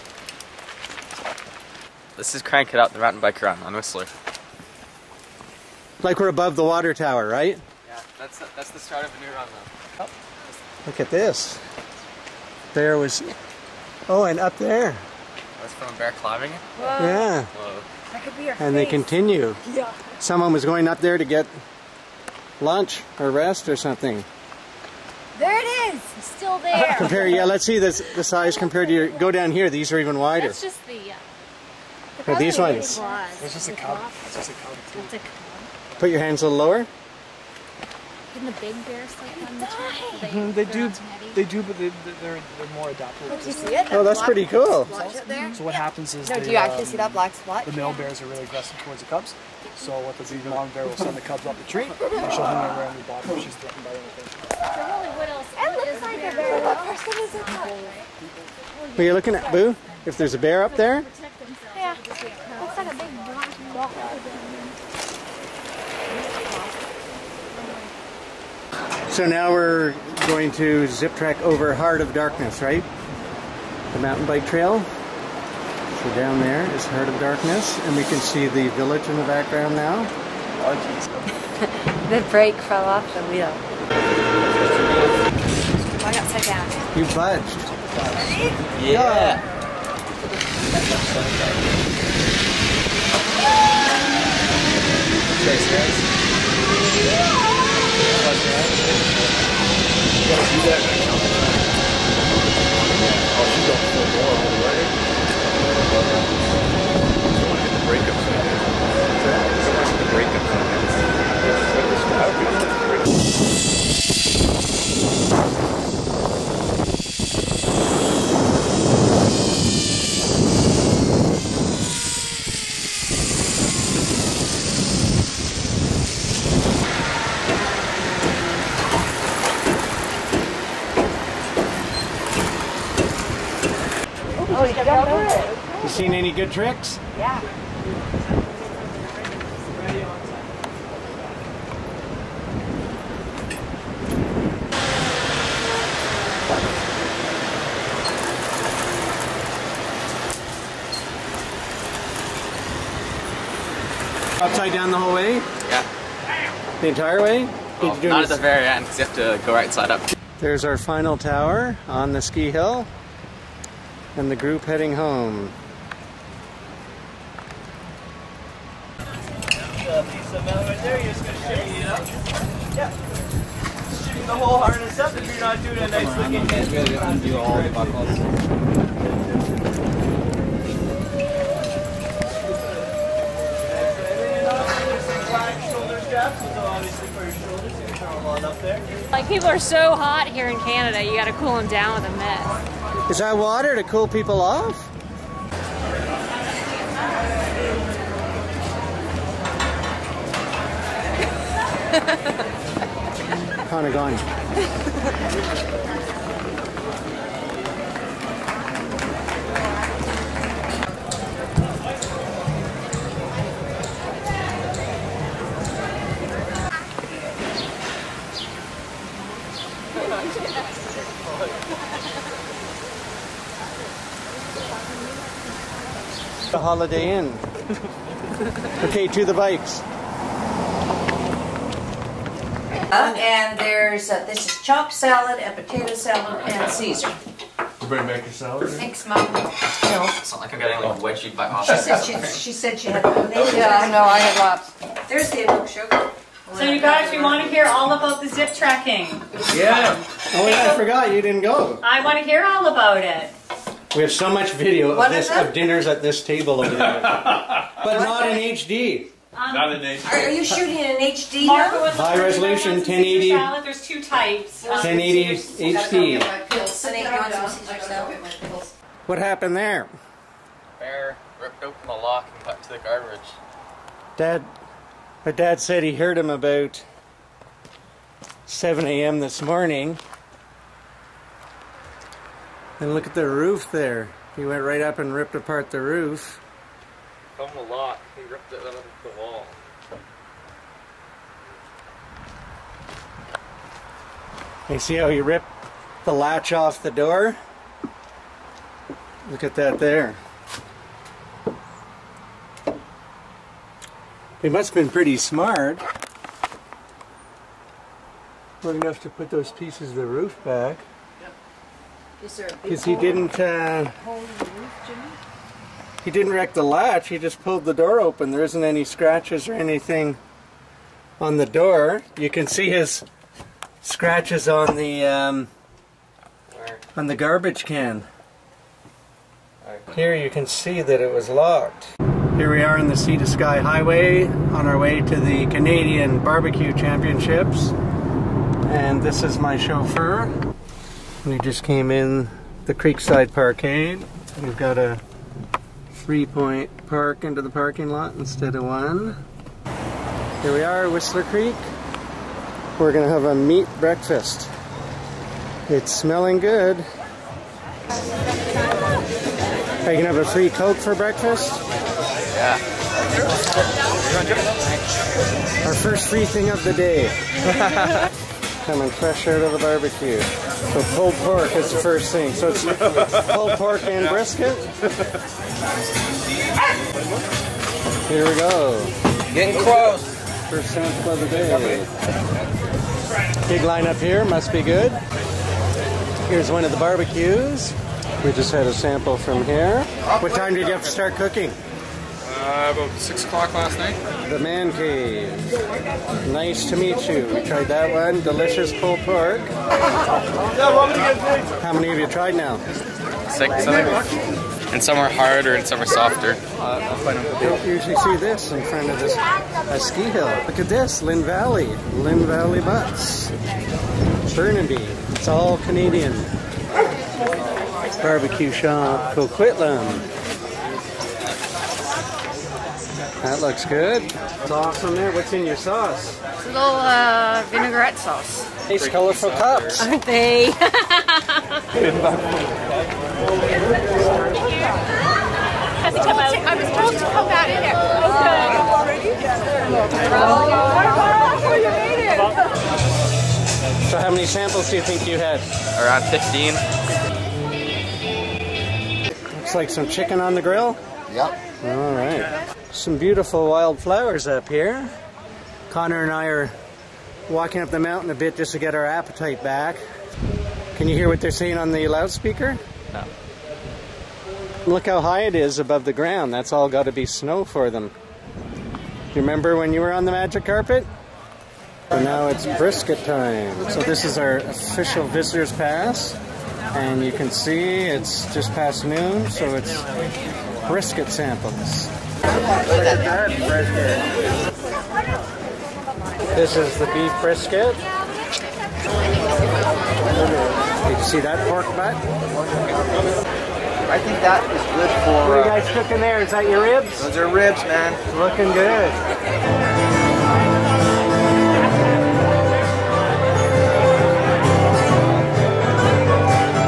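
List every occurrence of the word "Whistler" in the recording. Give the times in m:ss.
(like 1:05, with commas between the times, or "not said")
0:03, 5:50.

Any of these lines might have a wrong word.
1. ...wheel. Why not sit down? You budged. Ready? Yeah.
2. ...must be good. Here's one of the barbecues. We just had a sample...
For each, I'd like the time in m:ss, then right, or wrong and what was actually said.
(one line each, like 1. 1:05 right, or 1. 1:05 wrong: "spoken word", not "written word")
1. 1:23 right
2. 6:24 right.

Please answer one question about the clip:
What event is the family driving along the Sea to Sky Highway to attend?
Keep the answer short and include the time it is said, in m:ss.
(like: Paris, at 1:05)
Canadian Barbecue Championships, at 5:35.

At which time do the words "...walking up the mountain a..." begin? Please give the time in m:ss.
7:37.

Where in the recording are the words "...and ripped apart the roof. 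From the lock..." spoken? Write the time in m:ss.
4:44.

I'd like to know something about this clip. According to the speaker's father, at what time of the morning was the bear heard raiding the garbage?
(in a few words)
7 a.m.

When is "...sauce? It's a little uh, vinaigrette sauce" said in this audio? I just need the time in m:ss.
7:05.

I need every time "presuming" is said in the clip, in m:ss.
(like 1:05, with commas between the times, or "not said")
not said.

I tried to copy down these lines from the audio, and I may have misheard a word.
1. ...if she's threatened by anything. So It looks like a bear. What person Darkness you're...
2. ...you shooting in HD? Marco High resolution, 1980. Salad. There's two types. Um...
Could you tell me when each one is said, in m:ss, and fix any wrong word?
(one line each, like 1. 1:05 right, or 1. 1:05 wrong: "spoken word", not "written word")
1. 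0:53 wrong: "But", not "Darkness"
2. 4:20 wrong: "1080", not "1980".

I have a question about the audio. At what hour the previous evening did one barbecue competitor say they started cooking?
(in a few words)
6 o'clock.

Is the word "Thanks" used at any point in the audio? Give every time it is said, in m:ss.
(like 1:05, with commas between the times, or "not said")
1:35, 3:58.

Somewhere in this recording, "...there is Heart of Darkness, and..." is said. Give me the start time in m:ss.
1:16.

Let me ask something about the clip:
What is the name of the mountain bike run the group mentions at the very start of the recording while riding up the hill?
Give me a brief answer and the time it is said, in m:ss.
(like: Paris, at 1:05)
Crank It Up, at 0:02.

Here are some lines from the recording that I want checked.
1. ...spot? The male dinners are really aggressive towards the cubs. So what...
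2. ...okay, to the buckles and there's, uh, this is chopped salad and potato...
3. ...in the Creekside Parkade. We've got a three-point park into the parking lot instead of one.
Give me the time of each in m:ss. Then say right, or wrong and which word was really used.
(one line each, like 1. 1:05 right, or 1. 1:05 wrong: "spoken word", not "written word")
1. 0:47 wrong: "bears", not "dinners"
2. 3:48 wrong: "bikes", not "buckles"
3. 5:41 right.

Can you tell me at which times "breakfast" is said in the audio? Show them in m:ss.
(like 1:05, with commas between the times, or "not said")
5:53, 6:00.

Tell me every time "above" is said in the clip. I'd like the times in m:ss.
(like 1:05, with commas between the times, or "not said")
0:06, 7:45.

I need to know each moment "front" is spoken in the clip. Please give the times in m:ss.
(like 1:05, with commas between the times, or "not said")
6:48.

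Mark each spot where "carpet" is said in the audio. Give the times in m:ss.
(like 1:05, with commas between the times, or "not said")
7:50.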